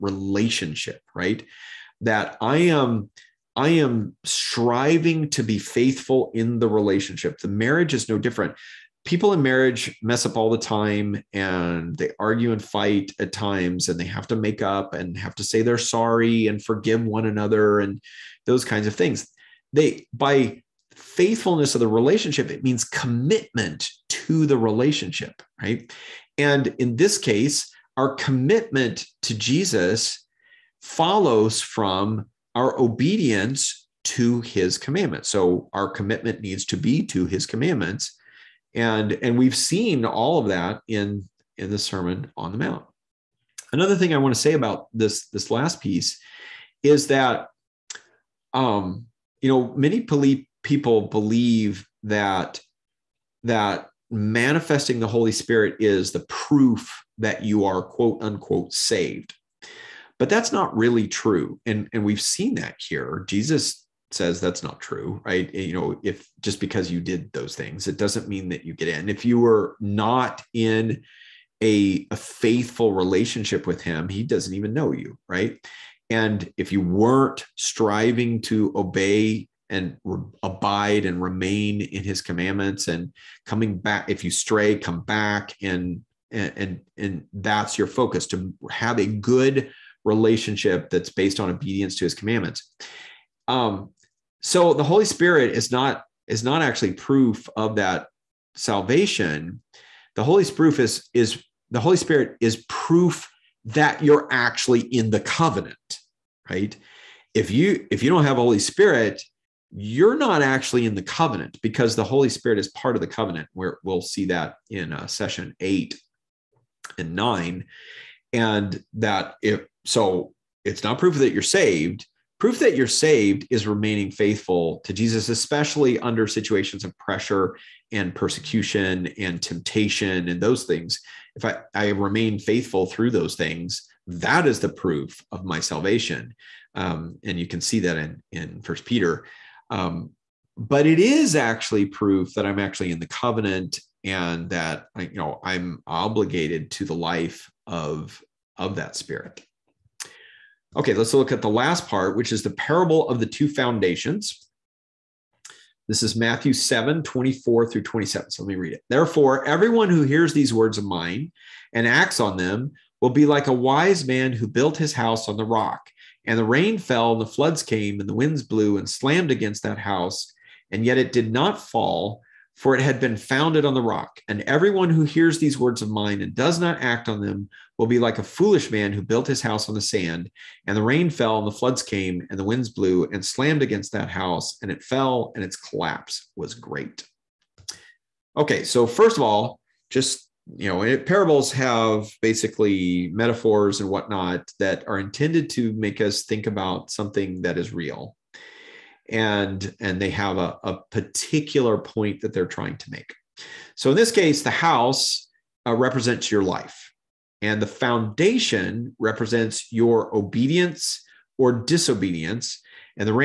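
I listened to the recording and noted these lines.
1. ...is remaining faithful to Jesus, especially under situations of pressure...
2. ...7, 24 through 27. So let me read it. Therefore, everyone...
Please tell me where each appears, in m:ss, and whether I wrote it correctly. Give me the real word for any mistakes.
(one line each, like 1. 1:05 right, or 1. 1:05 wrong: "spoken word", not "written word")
1. 2:03 right
2. 2:36 right.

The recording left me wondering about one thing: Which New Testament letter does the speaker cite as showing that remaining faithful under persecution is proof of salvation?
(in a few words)
First Peter.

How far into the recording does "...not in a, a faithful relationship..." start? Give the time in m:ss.
1:09.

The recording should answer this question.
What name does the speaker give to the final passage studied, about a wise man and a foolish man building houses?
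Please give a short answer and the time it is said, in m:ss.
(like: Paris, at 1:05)
The parable of the two foundations, at 2:32.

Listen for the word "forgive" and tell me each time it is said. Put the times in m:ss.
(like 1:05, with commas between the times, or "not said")
0:16.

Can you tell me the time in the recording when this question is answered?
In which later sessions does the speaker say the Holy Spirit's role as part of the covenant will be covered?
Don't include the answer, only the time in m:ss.
1:55.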